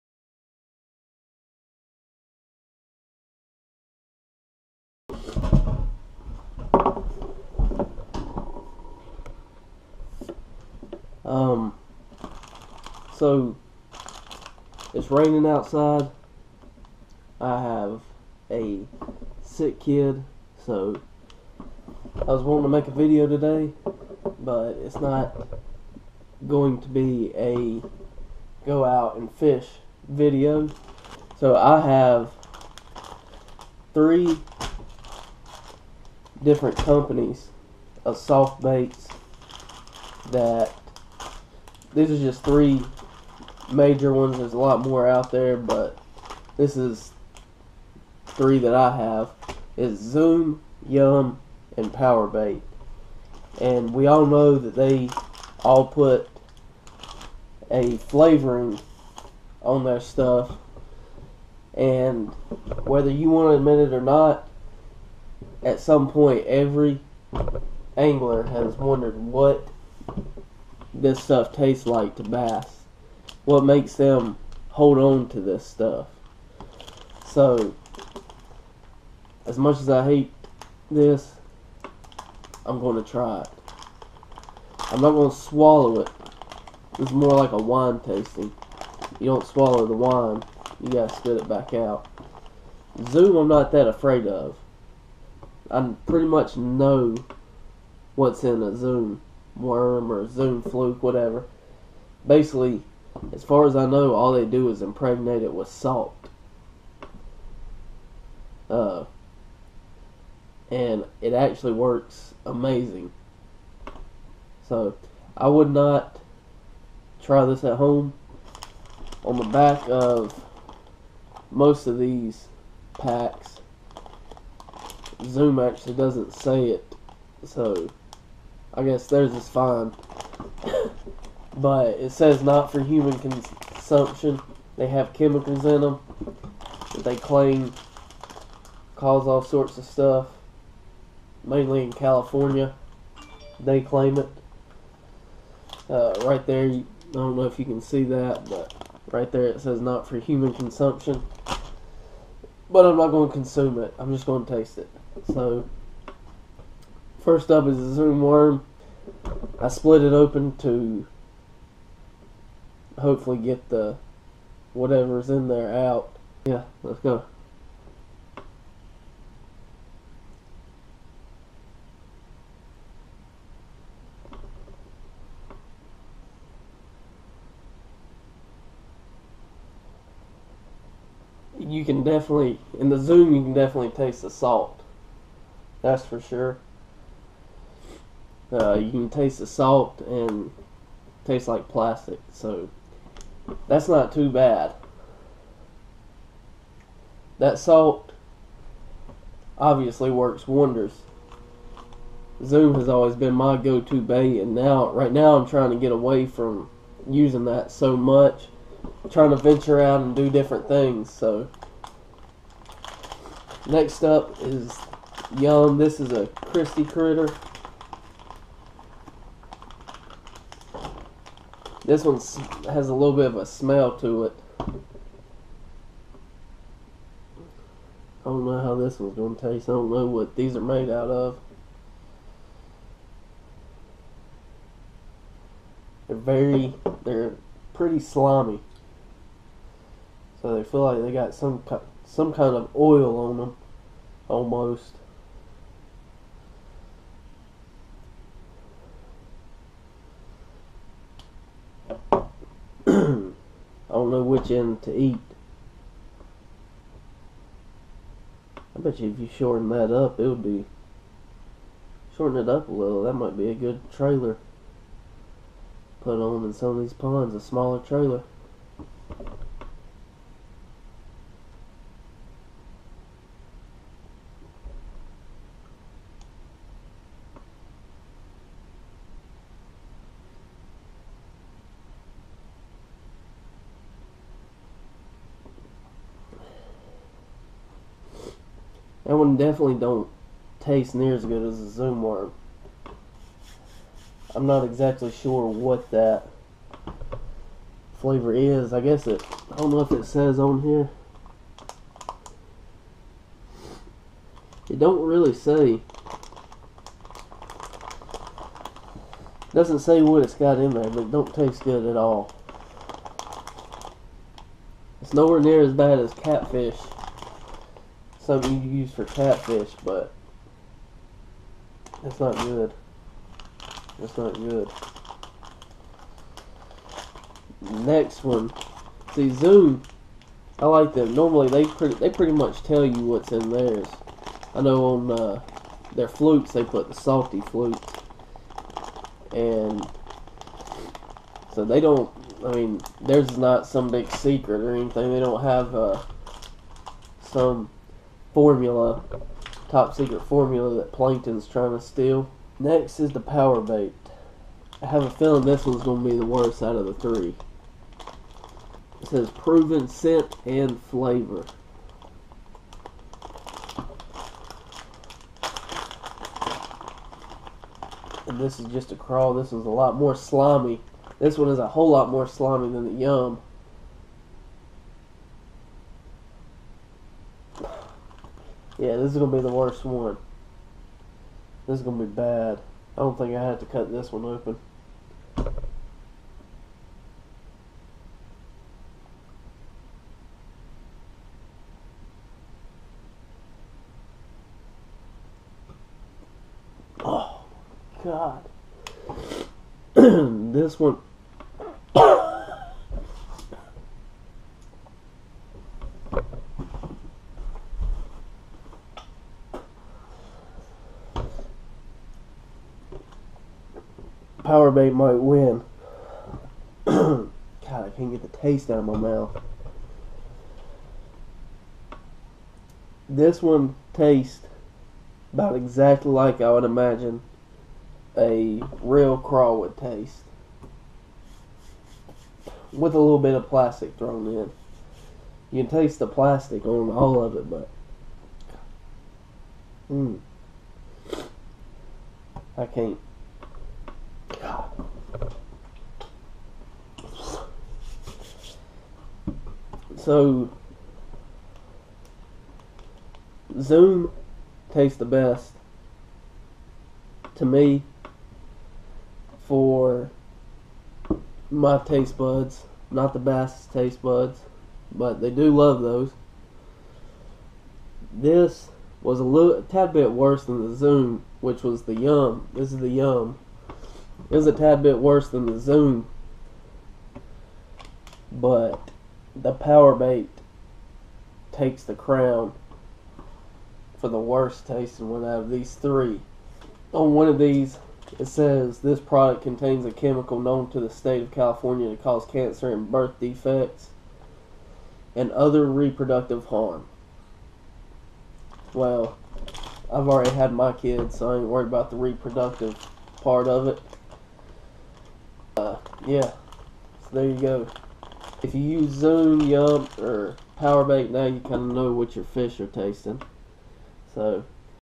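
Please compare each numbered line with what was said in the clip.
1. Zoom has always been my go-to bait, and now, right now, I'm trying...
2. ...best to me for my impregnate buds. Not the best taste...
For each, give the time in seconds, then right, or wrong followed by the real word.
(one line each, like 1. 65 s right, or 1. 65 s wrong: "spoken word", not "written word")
1. 202 s right
2. 455 s wrong: "taste", not "impregnate".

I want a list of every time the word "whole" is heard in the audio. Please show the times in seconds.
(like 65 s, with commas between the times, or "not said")
371 s.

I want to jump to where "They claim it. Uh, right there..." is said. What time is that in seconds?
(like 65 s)
143 s.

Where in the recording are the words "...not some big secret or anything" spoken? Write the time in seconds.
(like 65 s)
343 s.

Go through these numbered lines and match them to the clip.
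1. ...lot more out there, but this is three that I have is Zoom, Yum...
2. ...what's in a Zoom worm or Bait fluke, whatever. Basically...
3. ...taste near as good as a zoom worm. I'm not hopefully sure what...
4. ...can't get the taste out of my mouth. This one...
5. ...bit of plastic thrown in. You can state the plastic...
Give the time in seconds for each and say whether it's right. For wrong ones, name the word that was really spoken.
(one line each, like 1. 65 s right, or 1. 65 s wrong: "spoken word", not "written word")
1. 44 s right
2. 98 s wrong: "Zoom", not "Bait"
3. 290 s wrong: "exactly", not "hopefully"
4. 417 s right
5. 433 s wrong: "taste", not "state".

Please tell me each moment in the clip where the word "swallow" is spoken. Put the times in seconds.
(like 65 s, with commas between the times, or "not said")
85 s, 89 s.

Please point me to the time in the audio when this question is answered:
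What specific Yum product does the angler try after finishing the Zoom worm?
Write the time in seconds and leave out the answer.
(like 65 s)
216 s.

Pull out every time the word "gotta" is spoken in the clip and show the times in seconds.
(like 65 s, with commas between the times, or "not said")
90 s.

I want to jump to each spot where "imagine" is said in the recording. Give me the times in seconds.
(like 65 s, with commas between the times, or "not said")
426 s.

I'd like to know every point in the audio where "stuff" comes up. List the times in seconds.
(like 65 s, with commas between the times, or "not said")
59 s, 71 s, 75 s, 139 s.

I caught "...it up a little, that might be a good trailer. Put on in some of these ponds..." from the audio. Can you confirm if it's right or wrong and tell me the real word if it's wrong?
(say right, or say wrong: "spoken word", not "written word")
right.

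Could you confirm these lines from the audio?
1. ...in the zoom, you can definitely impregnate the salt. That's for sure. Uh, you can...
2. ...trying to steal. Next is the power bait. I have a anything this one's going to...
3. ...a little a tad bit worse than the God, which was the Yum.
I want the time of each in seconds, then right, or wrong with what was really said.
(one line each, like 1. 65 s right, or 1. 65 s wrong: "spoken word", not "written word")
1. 182 s wrong: "taste", not "impregnate"
2. 351 s wrong: "feeling", not "anything"
3. 469 s wrong: "Zoom", not "God".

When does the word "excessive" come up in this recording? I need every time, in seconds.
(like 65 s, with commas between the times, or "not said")
not said.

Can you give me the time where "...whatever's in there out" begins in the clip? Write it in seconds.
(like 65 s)
164 s.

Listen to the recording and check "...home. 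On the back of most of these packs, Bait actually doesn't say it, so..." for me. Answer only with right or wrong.
wrong.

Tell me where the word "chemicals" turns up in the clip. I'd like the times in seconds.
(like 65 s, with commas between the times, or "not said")
135 s, 489 s.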